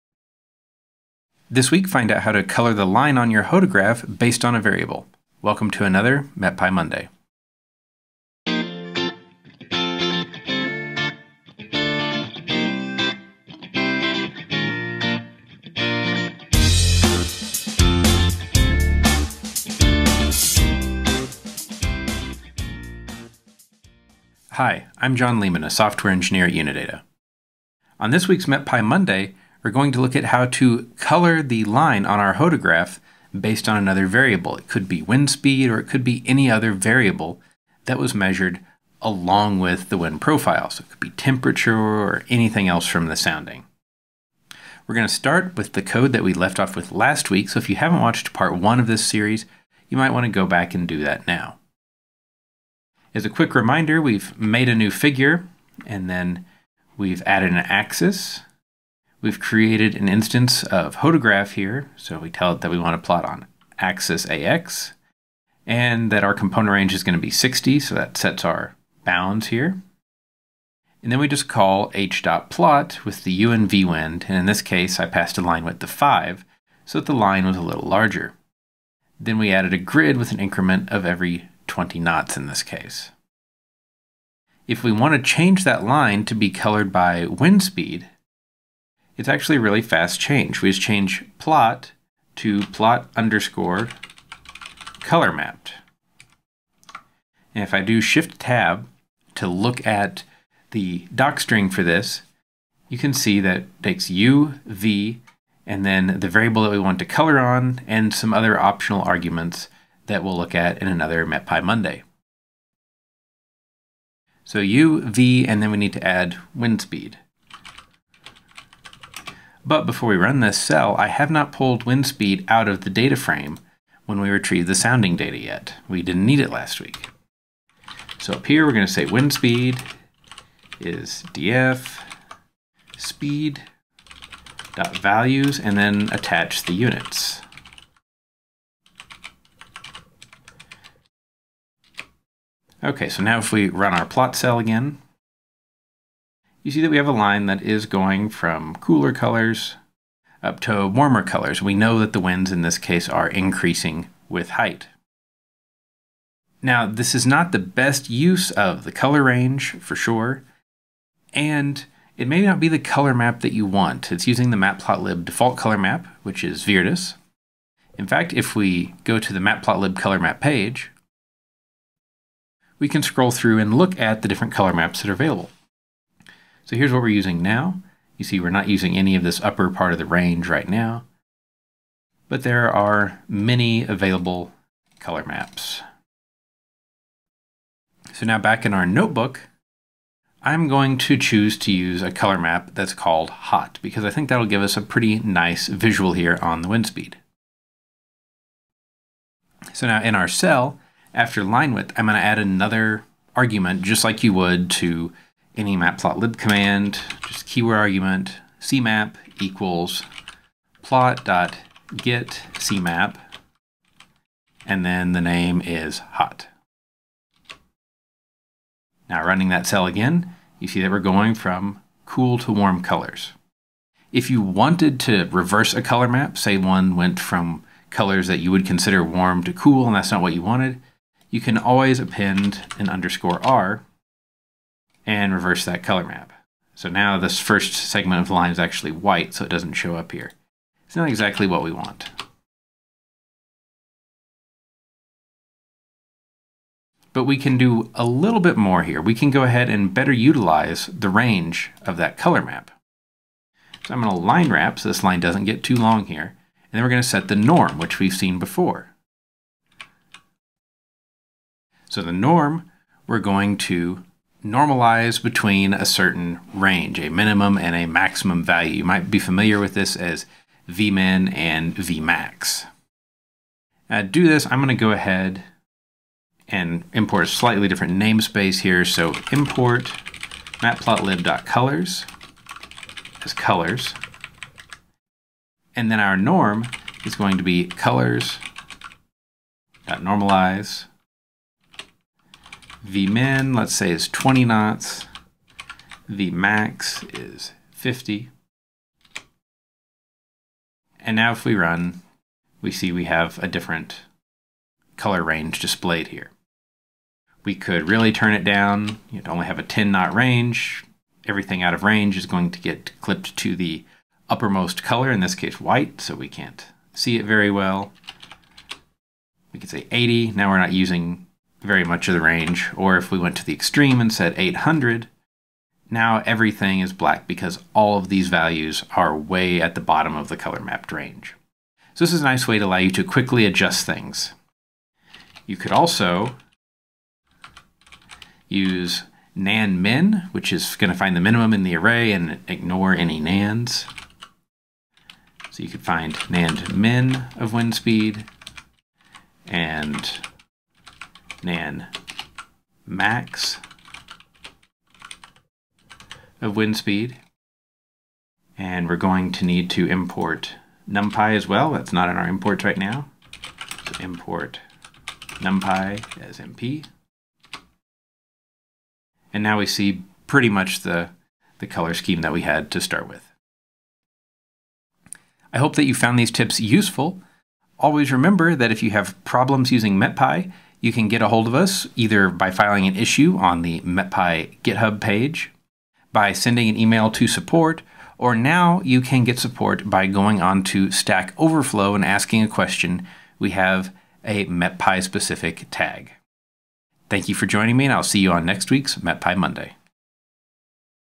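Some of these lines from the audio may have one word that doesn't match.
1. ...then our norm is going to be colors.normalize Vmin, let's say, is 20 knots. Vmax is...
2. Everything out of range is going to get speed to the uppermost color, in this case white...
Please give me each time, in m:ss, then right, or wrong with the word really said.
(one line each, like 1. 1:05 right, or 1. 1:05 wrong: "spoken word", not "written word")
1. 4:45 right
2. 5:11 wrong: "clipped", not "speed".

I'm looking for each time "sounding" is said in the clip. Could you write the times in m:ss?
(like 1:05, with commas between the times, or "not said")
0:43, 2:04.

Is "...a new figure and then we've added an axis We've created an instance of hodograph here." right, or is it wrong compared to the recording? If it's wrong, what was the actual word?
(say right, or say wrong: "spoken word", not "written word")
right.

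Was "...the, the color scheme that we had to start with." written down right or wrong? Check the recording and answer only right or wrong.
right.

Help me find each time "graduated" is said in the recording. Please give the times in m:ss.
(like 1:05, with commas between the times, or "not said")
not said.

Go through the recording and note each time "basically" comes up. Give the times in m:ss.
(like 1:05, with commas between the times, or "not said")
not said.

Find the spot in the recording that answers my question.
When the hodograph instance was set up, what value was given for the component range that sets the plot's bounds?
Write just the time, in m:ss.
1:07.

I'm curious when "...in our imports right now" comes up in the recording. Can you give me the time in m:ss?
6:02.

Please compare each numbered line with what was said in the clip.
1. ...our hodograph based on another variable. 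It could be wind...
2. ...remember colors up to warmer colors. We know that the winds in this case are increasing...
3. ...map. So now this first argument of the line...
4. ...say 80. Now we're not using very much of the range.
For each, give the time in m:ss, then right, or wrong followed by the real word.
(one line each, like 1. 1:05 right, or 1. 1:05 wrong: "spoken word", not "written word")
1. 0:32 right
2. 2:28 wrong: "cooler", not "remember"
3. 3:56 wrong: "segment", not "argument"
4. 5:19 right.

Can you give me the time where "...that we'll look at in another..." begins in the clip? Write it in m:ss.
1:50.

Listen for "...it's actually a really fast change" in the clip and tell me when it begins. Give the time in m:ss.
1:29.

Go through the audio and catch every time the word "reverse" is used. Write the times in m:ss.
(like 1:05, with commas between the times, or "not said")
3:45, 3:55.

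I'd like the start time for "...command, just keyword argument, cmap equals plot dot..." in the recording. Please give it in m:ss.
3:26.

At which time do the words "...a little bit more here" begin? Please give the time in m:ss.
4:07.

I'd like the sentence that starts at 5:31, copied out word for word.
So this is a nice way to allow you to quickly adjust things.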